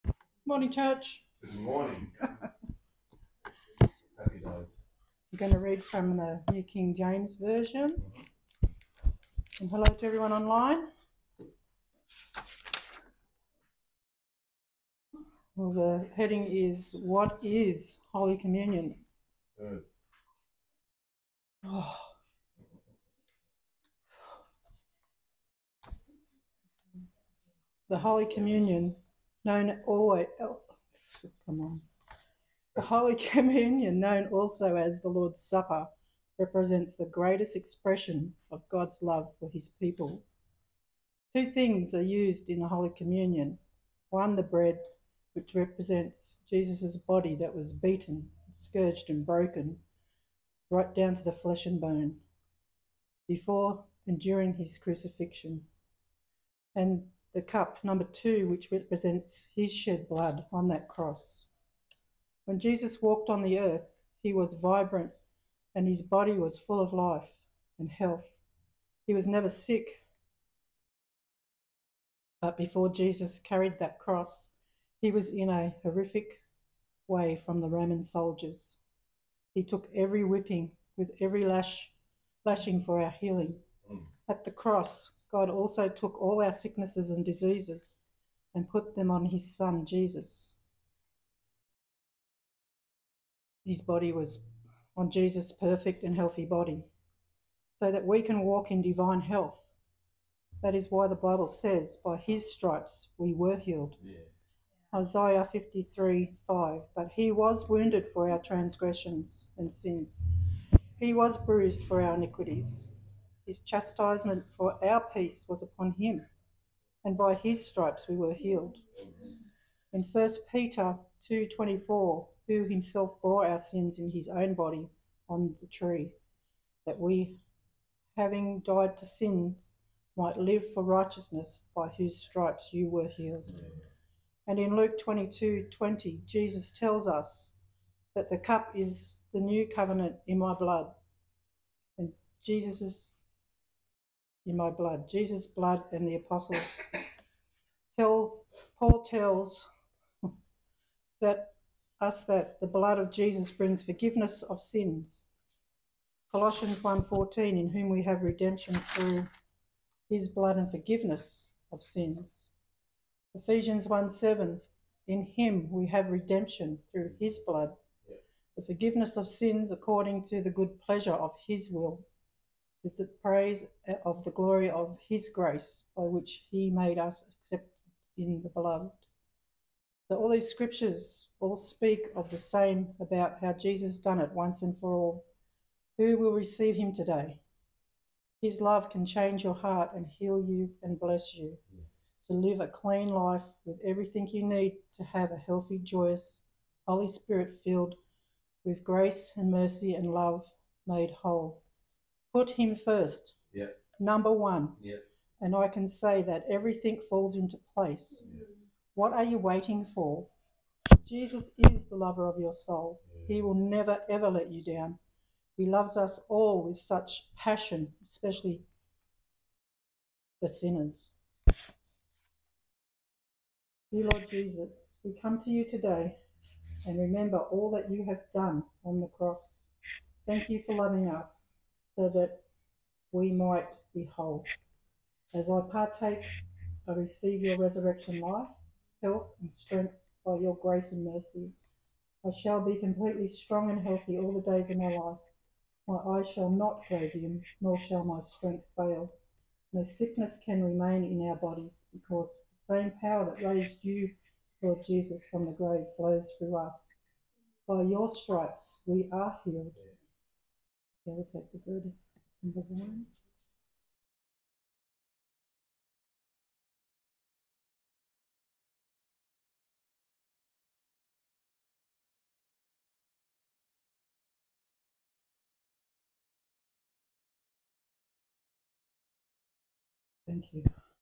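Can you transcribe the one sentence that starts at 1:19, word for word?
He took every whipping with every lash, lashing for our healing.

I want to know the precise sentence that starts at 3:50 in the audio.
Thank you for loving us so that we might be whole.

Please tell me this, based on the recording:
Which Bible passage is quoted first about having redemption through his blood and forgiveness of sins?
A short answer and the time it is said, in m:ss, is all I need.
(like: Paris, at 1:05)
Colossians 1:14, at 2:36.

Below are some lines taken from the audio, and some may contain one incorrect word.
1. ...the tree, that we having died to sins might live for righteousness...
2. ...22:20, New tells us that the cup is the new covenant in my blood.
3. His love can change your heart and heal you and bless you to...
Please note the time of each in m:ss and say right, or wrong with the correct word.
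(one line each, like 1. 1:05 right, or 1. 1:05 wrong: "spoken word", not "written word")
1. 2:05 right
2. 2:14 wrong: "Jesus", not "New"
3. 3:08 right.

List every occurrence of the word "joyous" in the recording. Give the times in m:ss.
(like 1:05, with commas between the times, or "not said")
3:15.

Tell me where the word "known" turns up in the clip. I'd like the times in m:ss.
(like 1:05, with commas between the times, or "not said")
0:29, 0:33.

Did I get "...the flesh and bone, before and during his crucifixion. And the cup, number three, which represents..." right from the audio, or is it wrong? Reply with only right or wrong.
wrong.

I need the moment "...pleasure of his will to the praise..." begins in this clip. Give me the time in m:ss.
2:50.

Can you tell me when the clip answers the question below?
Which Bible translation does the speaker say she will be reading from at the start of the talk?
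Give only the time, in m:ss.
0:06.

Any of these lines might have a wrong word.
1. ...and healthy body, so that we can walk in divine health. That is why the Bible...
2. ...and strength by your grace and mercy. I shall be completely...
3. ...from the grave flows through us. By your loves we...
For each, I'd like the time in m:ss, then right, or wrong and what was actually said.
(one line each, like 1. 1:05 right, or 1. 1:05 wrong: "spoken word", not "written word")
1. 1:36 right
2. 3:59 right
3. 4:15 wrong: "stripes", not "loves".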